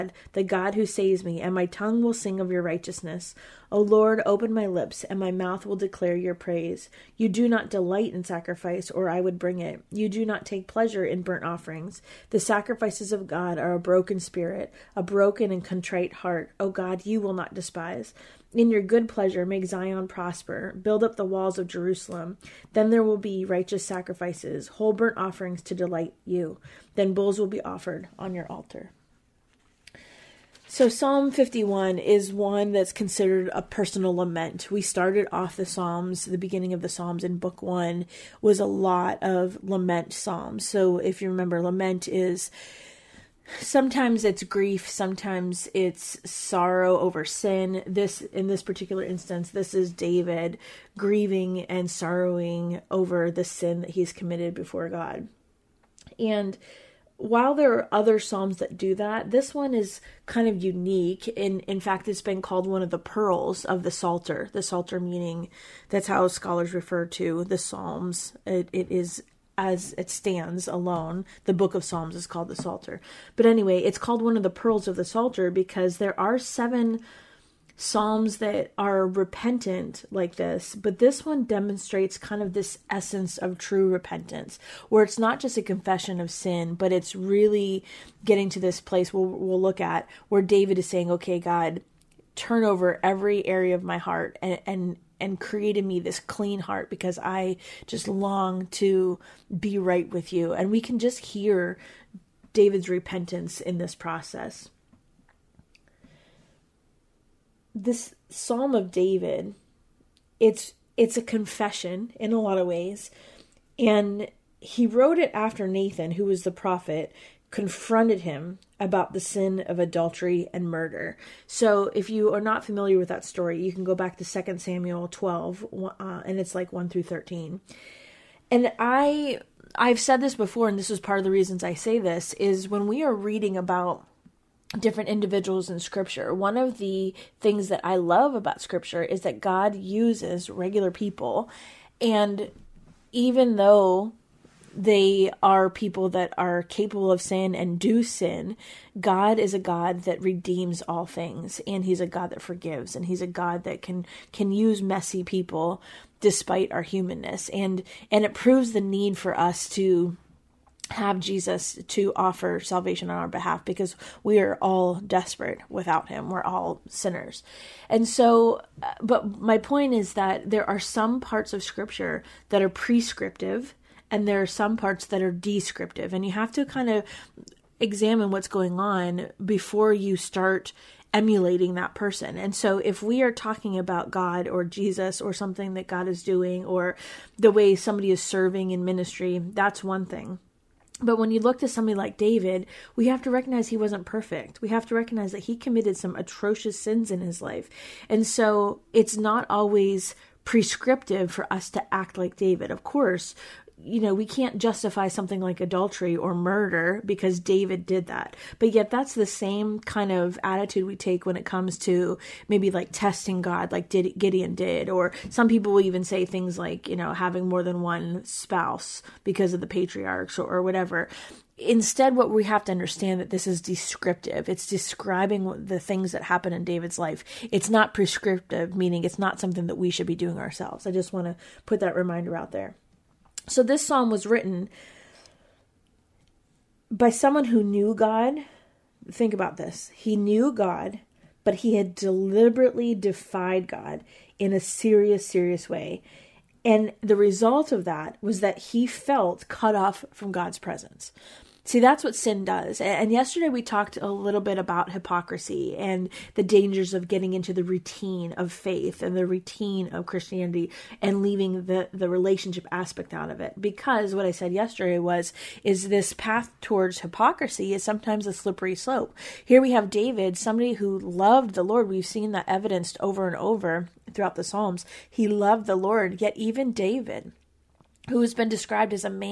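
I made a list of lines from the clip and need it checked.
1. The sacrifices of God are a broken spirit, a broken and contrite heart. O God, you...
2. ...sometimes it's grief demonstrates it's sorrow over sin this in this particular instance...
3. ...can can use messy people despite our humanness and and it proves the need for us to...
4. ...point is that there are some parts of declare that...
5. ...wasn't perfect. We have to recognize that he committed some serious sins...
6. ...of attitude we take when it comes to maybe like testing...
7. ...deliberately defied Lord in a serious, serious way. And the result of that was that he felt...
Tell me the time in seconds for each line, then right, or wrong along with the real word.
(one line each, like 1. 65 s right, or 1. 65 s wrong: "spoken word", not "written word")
1. 12 s right
2. 43 s wrong: "sometimes", not "demonstrates"
3. 153 s right
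4. 169 s wrong: "scripture", not "declare"
5. 193 s wrong: "atrocious", not "serious"
6. 210 s right
7. 241 s wrong: "God", not "Lord".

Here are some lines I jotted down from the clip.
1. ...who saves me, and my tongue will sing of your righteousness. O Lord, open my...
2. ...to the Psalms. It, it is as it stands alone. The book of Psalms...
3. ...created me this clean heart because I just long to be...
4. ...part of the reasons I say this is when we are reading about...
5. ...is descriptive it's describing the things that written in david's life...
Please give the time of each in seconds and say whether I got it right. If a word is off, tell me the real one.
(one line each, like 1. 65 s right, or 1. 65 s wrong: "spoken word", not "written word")
1. 0 s right
2. 67 s right
3. 95 s right
4. 131 s right
5. 223 s wrong: "happen", not "written".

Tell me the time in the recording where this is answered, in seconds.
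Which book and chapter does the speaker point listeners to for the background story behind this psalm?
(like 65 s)
124 s.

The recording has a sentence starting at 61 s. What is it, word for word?
In in fact, it's been called one of the pearls of the Psalter.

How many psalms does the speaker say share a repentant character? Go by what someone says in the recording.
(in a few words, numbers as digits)
7.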